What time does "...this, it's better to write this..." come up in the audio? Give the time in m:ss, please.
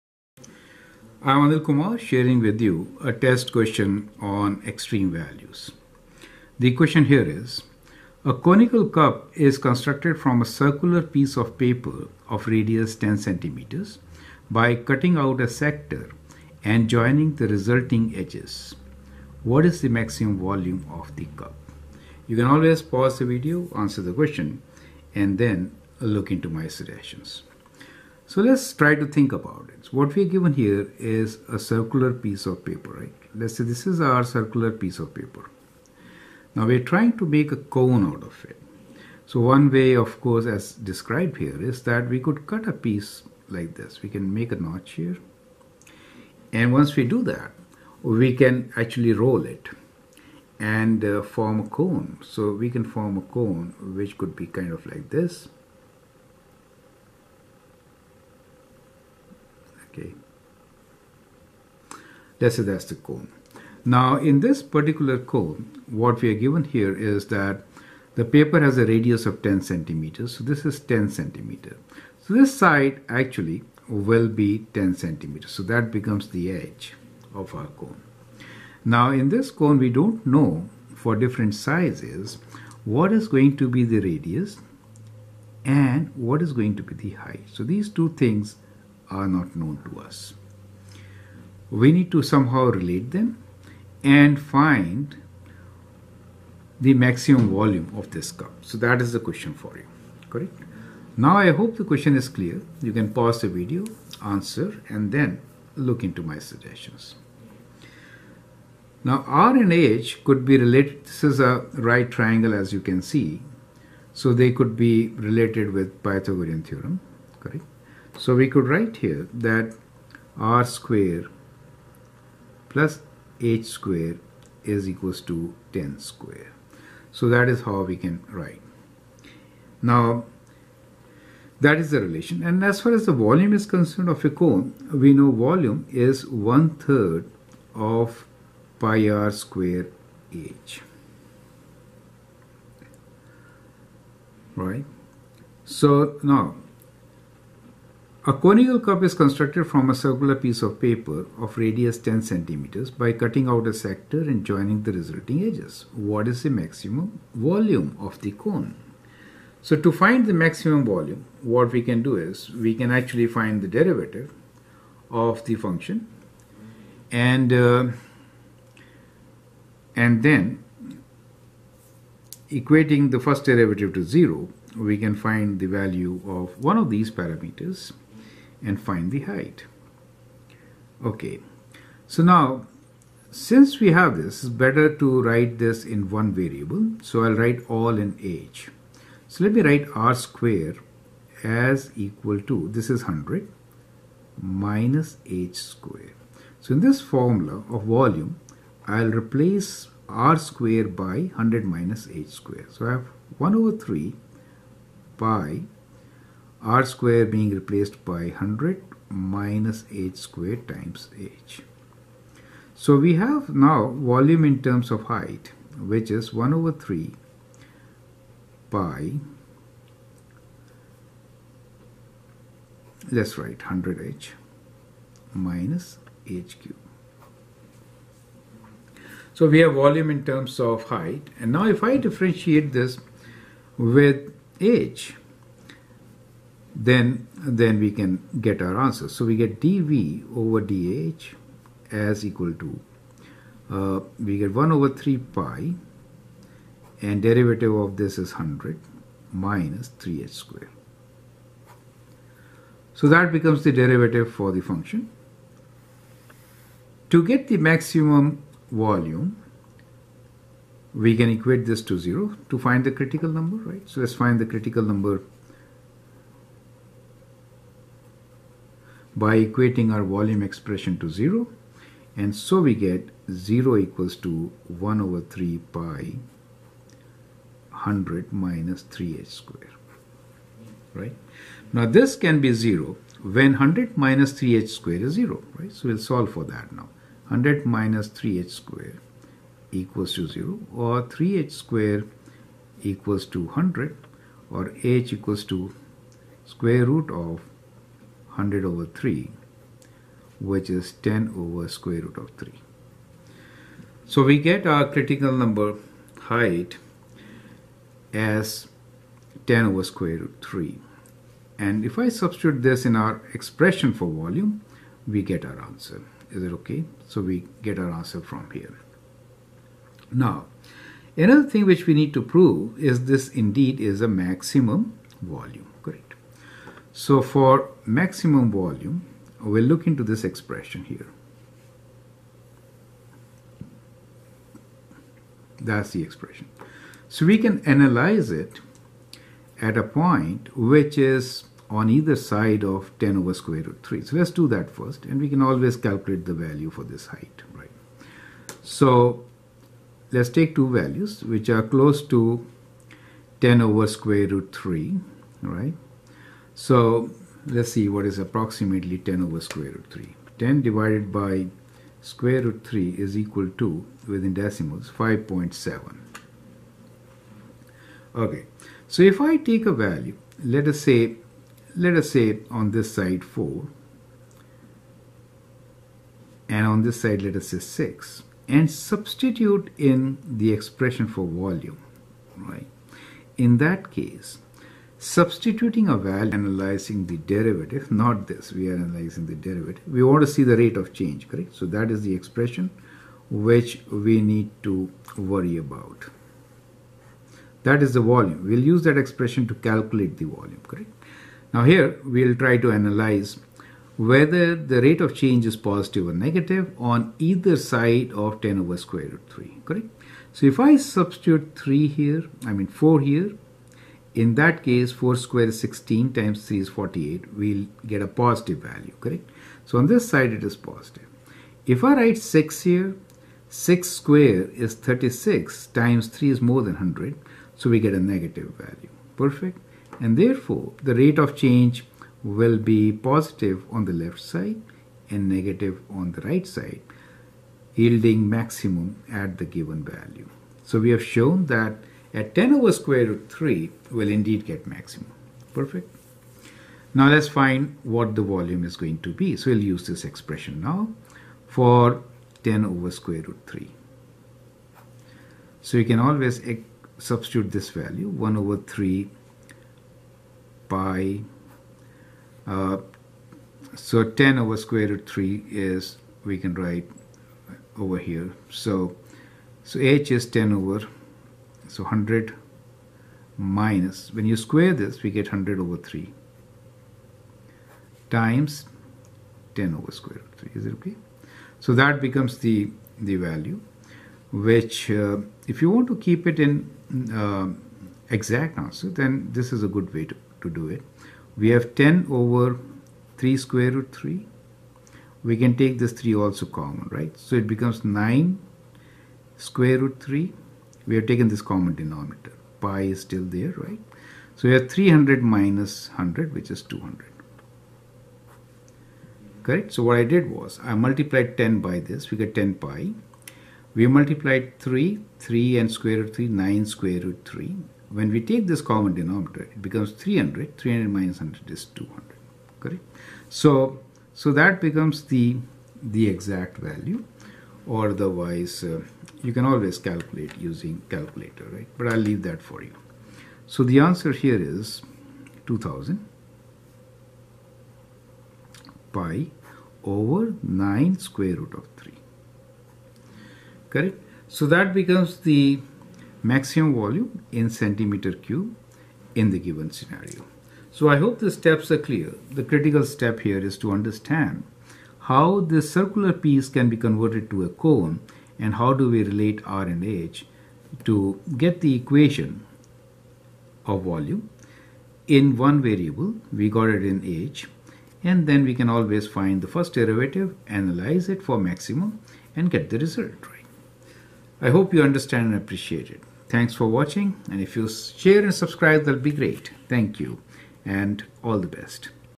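3:04.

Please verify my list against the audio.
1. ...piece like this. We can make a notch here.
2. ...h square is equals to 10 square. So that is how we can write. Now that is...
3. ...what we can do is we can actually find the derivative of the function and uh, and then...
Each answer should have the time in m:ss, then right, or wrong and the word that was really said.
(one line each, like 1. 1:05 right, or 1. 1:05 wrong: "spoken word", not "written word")
1. 0:42 right
2. 2:03 right
3. 2:41 right.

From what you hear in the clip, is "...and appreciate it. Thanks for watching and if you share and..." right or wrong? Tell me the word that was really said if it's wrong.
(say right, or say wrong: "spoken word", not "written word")
right.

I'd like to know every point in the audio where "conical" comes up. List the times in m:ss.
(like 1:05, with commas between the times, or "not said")
0:08, 2:28.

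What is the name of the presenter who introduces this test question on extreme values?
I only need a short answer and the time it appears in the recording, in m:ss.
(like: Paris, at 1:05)
Anil Kumar, at 0:01.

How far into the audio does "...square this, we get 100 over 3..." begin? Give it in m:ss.
7:54.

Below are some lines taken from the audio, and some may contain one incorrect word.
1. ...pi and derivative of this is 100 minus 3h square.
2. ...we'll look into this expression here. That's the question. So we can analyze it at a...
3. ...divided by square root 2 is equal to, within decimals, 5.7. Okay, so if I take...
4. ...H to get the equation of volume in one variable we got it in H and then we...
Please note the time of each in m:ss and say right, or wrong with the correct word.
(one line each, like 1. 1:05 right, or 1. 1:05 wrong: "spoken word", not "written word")
1. 4:05 right
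2. 5:29 wrong: "expression", not "question"
3. 6:00 wrong: "3", not "2"
4. 9:19 right.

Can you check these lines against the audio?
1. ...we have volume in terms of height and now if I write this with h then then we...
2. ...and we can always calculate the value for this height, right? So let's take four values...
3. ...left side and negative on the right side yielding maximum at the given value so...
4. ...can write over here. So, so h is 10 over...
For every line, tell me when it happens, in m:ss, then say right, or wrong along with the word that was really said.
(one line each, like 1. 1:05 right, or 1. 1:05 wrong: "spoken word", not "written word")
1. 3:49 wrong: "differentiate", not "write"
2. 5:45 wrong: "two", not "four"
3. 7:13 right
4. 7:46 right.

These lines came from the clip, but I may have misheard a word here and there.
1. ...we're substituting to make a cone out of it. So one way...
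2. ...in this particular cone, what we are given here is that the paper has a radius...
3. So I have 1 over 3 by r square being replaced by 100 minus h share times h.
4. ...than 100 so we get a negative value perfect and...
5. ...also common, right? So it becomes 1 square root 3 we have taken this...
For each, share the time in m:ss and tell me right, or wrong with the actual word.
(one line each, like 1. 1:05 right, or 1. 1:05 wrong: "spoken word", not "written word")
1. 0:36 wrong: "trying", not "substituting"
2. 1:04 right
3. 3:22 wrong: "square", not "share"
4. 7:06 right
5. 8:16 wrong: "9", not "1".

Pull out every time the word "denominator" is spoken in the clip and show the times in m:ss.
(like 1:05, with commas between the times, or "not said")
8:21, 8:38.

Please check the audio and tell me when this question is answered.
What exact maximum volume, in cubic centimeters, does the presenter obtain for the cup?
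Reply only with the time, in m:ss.
8:55.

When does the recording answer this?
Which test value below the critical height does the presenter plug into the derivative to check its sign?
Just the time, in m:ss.
6:12.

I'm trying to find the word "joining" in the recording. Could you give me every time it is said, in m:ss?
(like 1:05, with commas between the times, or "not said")
0:16, 2:34.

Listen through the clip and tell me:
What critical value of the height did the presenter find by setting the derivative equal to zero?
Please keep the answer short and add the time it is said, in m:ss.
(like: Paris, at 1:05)
10 over square root of 3, at 5:01.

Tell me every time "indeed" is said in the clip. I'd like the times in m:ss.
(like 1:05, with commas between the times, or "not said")
5:23, 7:24.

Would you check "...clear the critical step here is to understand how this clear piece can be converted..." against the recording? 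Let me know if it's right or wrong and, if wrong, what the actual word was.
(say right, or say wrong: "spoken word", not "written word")
wrong: "circular", not "clear".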